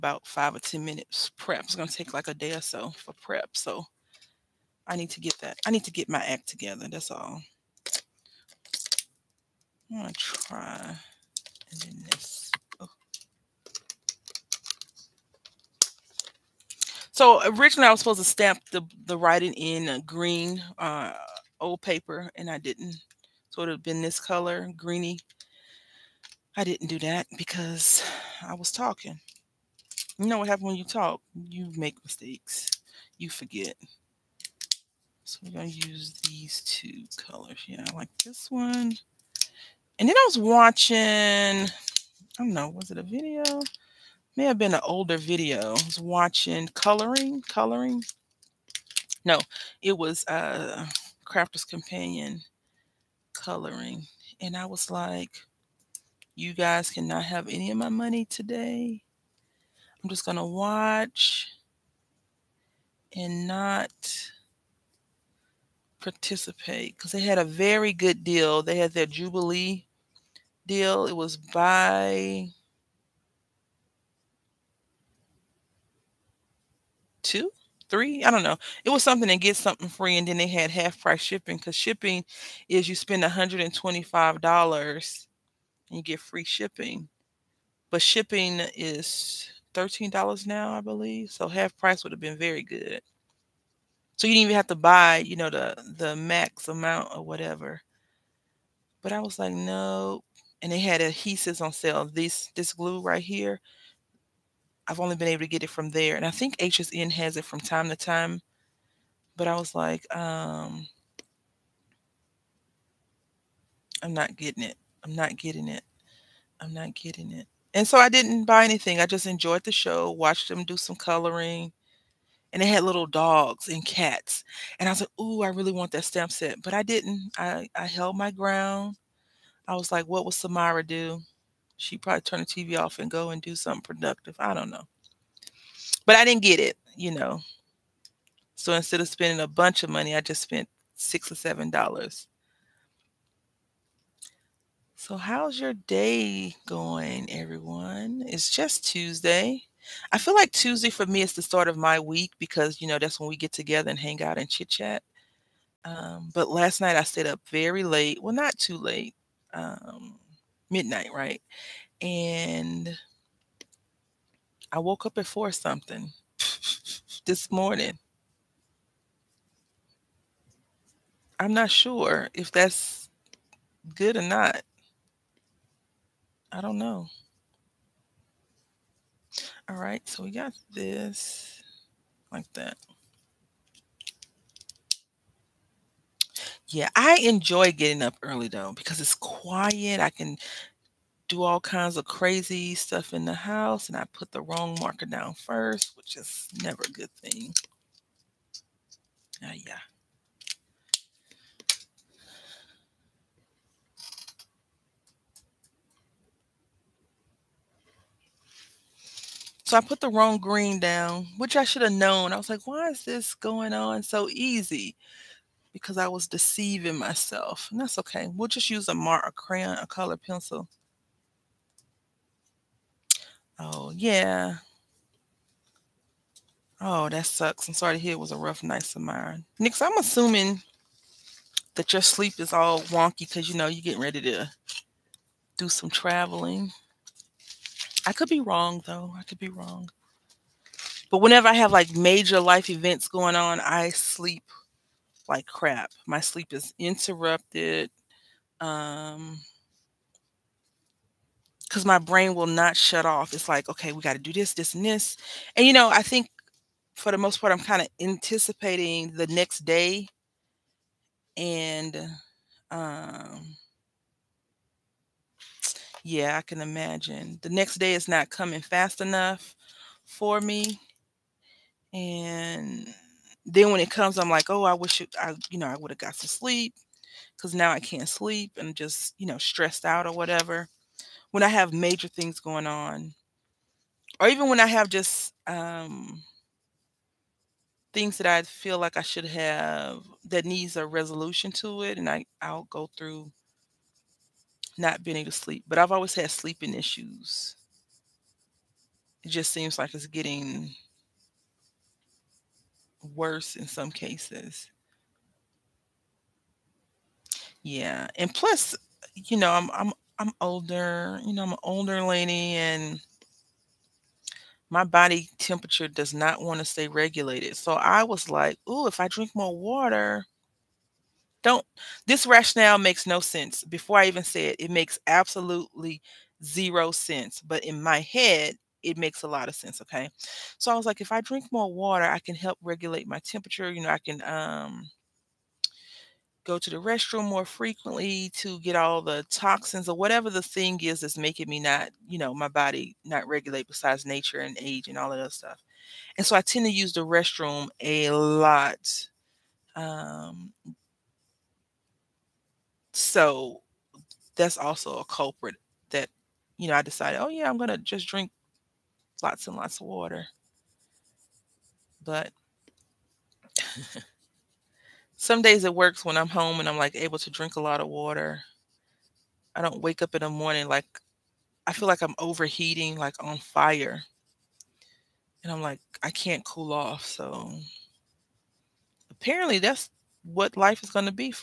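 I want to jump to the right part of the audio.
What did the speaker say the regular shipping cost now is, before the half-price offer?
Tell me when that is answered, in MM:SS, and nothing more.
01:29.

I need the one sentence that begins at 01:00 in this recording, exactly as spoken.
I'm just going to watch and not participate because they had a very good deal.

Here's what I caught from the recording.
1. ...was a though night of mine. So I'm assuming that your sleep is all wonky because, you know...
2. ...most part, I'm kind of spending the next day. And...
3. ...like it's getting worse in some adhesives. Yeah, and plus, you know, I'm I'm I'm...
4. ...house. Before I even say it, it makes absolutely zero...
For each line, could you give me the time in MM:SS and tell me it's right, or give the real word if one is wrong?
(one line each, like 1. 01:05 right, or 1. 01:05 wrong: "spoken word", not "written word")
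1. 03:48 wrong: "rough", not "though"
2. 04:17 wrong: "anticipating", not "spending"
3. 04:59 wrong: "cases", not "adhesives"
4. 05:23 wrong: "sense", not "house".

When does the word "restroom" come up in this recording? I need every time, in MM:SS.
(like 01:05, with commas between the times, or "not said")
05:36, 05:47.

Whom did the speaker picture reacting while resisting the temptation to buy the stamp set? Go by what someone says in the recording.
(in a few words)
Samara.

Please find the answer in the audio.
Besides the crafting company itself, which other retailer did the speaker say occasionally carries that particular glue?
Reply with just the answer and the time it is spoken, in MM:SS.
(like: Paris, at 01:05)
HSN, at 01:46.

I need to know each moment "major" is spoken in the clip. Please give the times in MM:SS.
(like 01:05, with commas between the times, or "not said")
04:01, 04:41.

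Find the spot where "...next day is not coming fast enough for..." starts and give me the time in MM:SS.
04:27.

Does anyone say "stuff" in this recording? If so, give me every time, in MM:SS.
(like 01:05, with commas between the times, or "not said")
03:12, 05:45.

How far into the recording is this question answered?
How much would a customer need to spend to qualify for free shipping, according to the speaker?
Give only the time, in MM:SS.
01:23.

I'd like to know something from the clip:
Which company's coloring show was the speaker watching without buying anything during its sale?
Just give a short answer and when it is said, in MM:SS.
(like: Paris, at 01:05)
Crafter's Companion, at 00:51.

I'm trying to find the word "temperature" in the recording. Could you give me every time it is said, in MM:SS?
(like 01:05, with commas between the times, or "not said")
05:15, 05:33.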